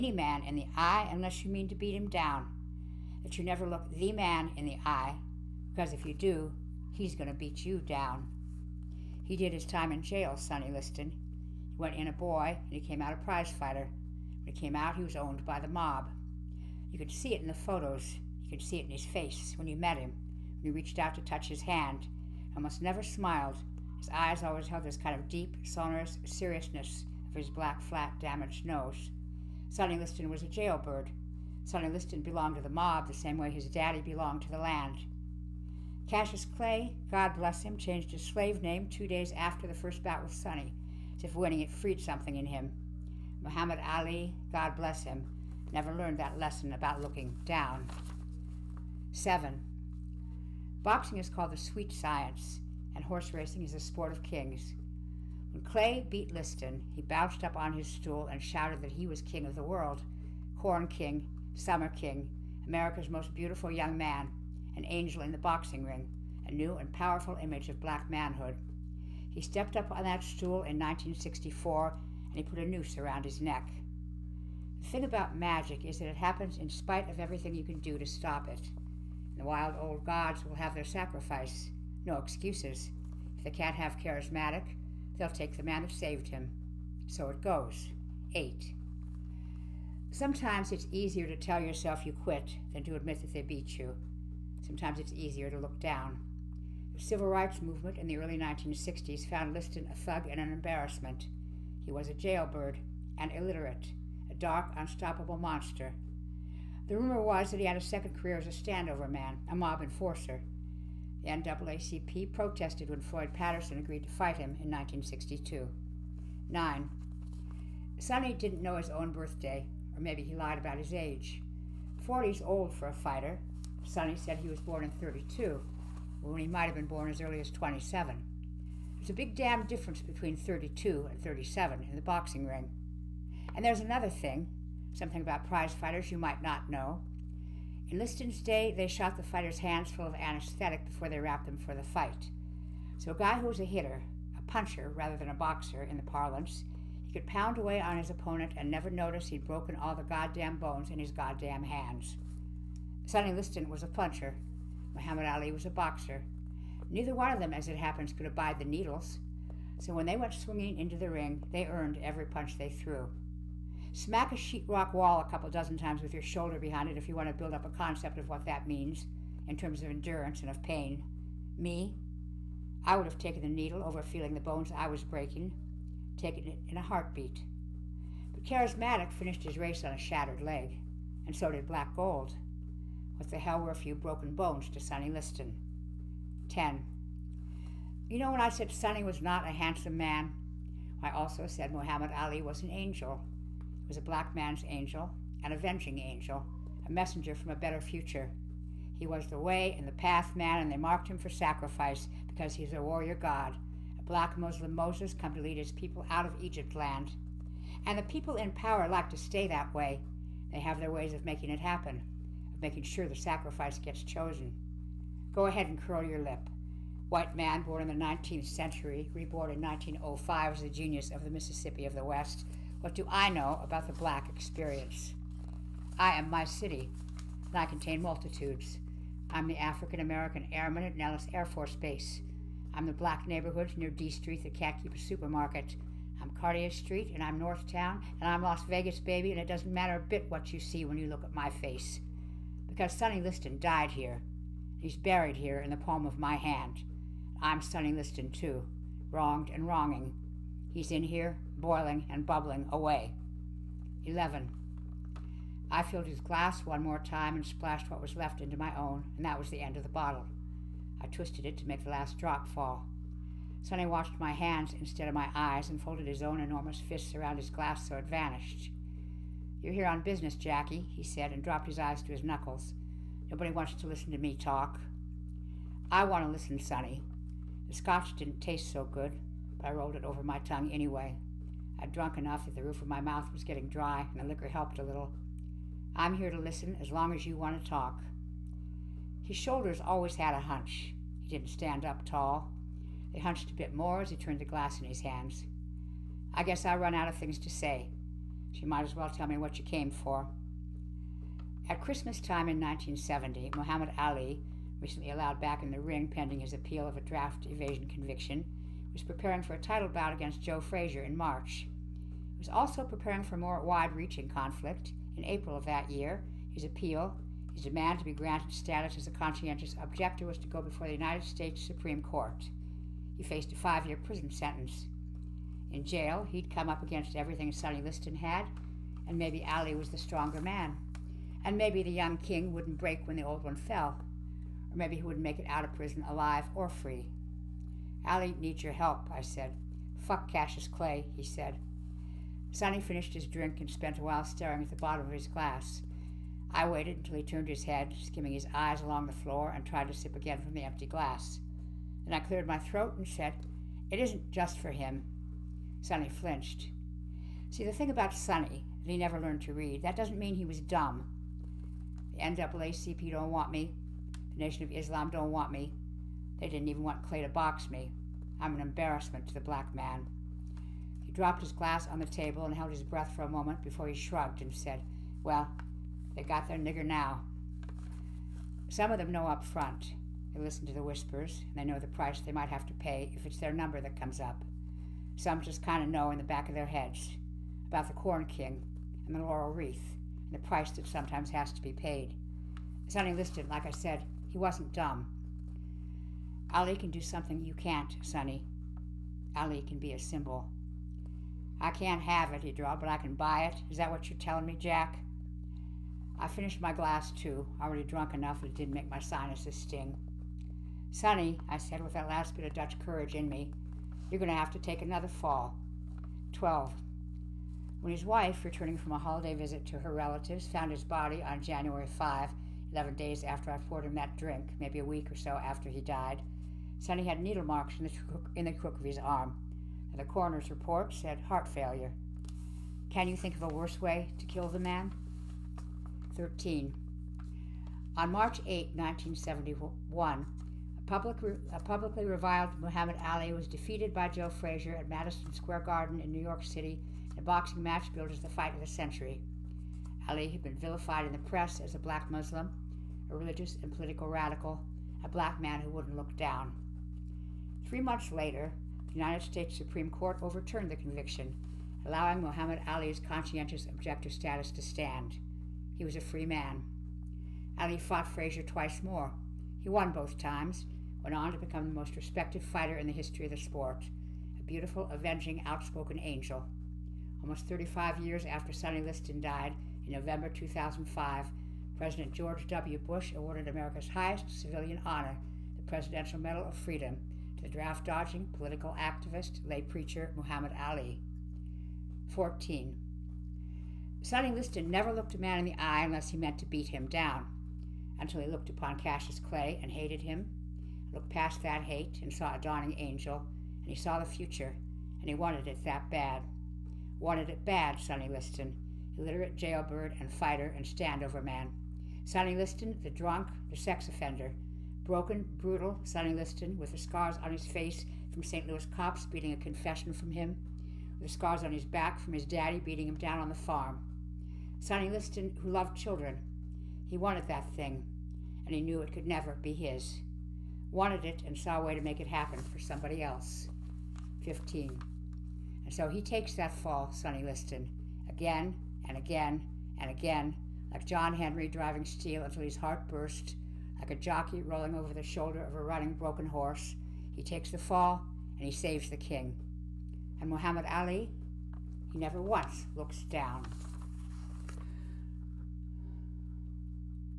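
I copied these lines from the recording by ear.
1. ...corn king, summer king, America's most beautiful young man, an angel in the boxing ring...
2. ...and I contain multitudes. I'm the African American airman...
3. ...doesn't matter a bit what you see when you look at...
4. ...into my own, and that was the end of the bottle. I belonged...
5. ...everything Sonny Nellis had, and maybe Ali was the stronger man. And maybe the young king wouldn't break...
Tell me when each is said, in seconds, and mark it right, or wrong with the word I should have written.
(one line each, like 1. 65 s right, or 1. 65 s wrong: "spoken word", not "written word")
1. 60 s right
2. 227 s right
3. 239 s right
4. 258 s wrong: "twisted", not "belonged"
5. 327 s wrong: "Liston", not "Nellis".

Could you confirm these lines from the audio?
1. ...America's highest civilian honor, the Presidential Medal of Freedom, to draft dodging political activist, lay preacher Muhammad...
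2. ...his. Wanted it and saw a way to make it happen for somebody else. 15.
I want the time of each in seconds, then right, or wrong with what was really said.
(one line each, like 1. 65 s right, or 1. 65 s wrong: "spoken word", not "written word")
1. 483 s right
2. 529 s right.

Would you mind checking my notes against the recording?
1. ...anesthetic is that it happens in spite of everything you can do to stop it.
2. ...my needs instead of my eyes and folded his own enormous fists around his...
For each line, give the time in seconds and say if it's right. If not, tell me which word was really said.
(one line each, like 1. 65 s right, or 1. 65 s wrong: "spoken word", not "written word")
1. 75 s wrong: "magic", not "anesthetic"
2. 264 s wrong: "hands", not "needs".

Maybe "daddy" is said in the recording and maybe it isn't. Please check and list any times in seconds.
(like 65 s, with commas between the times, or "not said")
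33 s, 522 s.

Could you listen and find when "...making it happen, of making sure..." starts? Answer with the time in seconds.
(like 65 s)
211 s.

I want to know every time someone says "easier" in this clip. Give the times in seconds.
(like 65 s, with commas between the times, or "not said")
90 s, 95 s.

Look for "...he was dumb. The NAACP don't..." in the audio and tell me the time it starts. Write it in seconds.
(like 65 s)
360 s.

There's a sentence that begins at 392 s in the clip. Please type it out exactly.
Sonny Liston, like I said, he wasn't dumb.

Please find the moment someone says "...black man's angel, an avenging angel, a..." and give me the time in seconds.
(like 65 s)
194 s.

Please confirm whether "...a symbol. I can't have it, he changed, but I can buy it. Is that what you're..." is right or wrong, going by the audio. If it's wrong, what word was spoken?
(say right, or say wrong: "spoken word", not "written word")
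wrong: "drawled", not "changed".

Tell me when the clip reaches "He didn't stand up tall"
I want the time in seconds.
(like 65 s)
291 s.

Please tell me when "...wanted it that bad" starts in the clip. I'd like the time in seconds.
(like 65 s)
505 s.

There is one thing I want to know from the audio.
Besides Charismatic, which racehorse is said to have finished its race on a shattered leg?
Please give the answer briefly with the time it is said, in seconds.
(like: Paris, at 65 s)
Black Gold, at 181 s.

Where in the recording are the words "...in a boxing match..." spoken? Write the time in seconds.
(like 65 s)
447 s.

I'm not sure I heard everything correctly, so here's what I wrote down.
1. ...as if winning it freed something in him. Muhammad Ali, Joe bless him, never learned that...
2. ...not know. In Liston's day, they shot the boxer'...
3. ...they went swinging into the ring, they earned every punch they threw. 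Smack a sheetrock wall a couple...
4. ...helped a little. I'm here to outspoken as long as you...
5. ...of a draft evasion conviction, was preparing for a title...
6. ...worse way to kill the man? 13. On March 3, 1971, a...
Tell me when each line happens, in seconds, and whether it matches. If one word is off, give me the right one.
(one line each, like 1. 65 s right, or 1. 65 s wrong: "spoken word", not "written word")
1. 41 s wrong: "God", not "Joe"
2. 136 s wrong: "fighters", not "boxer"
3. 160 s right
4. 284 s wrong: "listen", not "outspoken"
5. 306 s right
6. 433 s wrong: "8", not "3".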